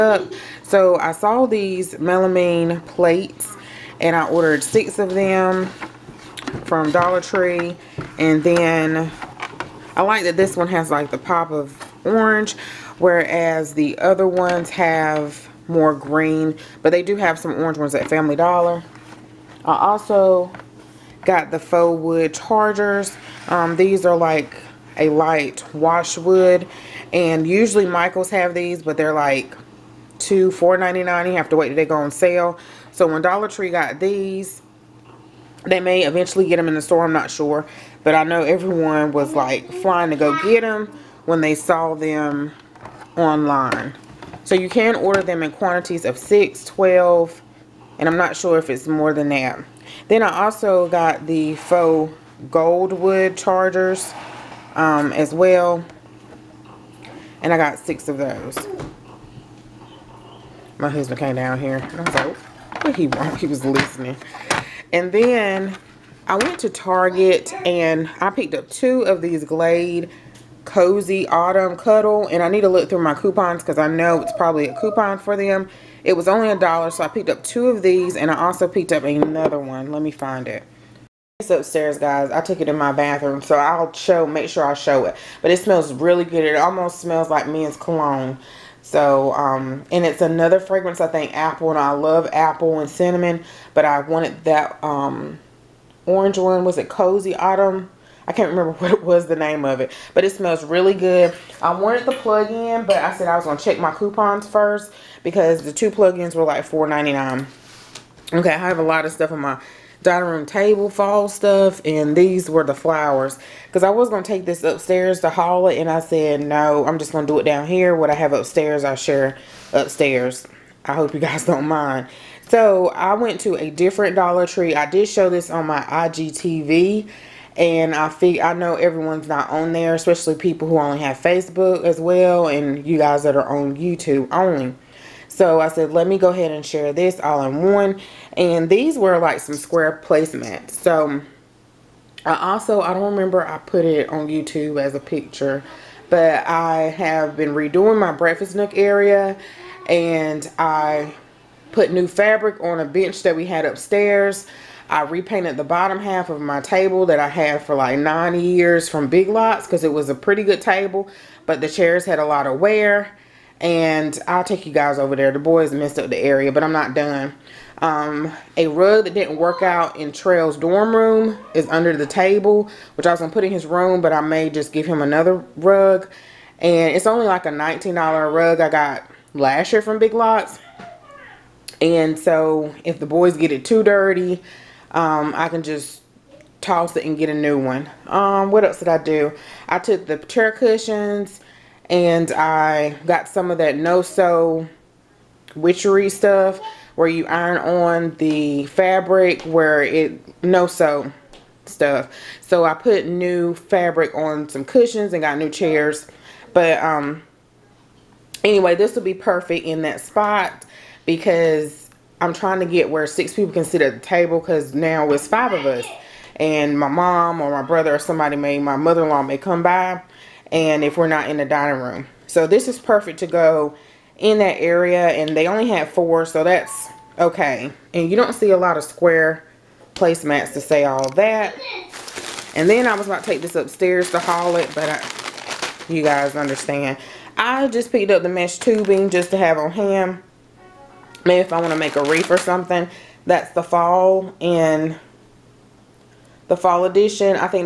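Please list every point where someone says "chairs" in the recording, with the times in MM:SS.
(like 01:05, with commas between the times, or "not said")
02:41, 03:10, 03:25.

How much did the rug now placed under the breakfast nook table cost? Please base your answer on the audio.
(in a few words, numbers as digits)
$19.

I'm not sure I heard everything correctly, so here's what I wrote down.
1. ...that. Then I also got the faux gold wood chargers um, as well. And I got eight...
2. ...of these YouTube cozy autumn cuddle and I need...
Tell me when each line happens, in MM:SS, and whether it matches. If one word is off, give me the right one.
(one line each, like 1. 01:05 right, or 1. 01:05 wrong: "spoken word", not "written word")
1. 00:49 wrong: "six", not "eight"
2. 01:09 wrong: "Glade", not "YouTube".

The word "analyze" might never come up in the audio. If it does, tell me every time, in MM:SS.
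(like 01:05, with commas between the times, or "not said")
not said.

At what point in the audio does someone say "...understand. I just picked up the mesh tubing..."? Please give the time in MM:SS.
03:56.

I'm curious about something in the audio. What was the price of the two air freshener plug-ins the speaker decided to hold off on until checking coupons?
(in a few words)
$4.99.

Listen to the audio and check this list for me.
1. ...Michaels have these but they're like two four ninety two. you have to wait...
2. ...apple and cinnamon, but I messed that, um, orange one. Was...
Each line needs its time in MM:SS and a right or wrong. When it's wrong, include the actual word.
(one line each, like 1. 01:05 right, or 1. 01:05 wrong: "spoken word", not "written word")
1. 00:27 wrong: "nine", not "two"
2. 01:32 wrong: "wanted", not "messed".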